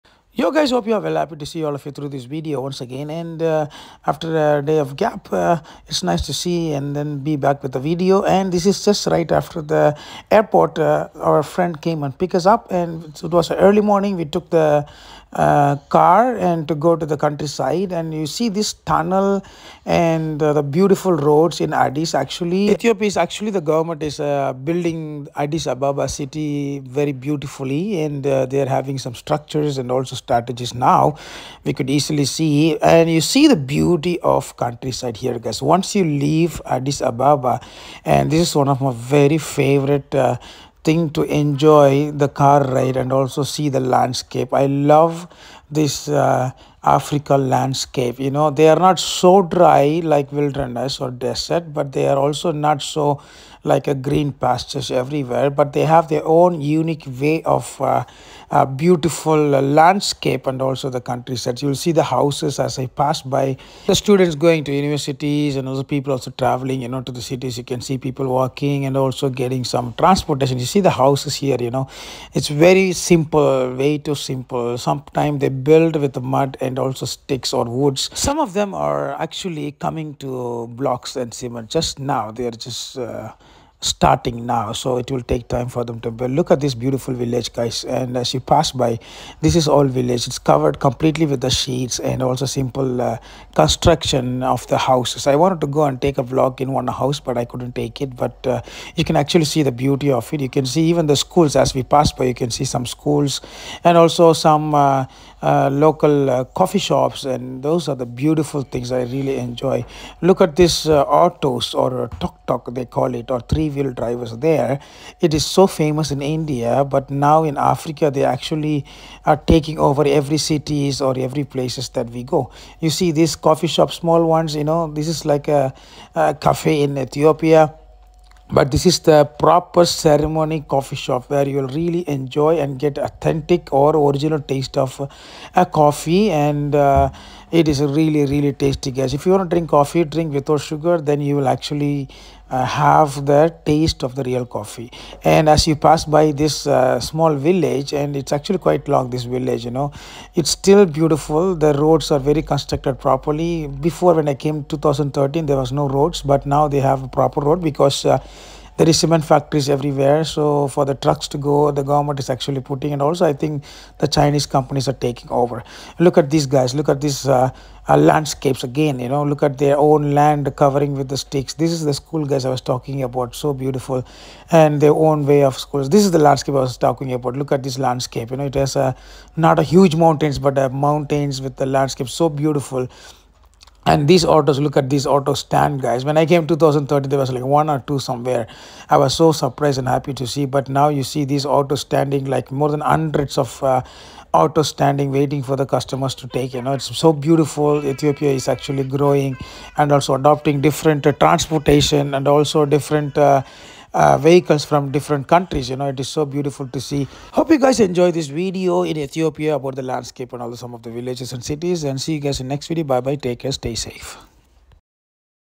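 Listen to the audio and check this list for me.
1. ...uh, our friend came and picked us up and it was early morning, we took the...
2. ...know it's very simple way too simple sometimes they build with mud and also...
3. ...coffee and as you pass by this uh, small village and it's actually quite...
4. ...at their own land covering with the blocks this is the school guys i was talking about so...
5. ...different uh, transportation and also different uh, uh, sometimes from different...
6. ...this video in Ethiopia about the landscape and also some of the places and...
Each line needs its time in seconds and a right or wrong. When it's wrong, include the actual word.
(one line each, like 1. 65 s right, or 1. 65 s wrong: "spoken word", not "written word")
1. 10 s right
2. 71 s right
3. 144 s right
4. 169 s wrong: "sticks", not "blocks"
5. 200 s wrong: "vehicles", not "sometimes"
6. 208 s wrong: "villages", not "places".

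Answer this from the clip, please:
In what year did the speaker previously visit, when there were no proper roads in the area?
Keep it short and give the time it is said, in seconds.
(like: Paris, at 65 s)
2013, at 154 s.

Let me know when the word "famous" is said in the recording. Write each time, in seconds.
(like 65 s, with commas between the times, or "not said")
115 s.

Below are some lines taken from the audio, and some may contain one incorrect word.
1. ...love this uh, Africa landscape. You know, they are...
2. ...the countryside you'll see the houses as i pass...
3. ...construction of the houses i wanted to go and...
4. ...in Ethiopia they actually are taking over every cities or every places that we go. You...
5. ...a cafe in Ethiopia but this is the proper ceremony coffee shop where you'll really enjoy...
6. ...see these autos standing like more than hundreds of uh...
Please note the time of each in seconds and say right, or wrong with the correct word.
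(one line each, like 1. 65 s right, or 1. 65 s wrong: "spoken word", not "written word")
1. 44 s right
2. 60 s right
3. 93 s right
4. 117 s wrong: "Africa", not "Ethiopia"
5. 126 s right
6. 191 s right.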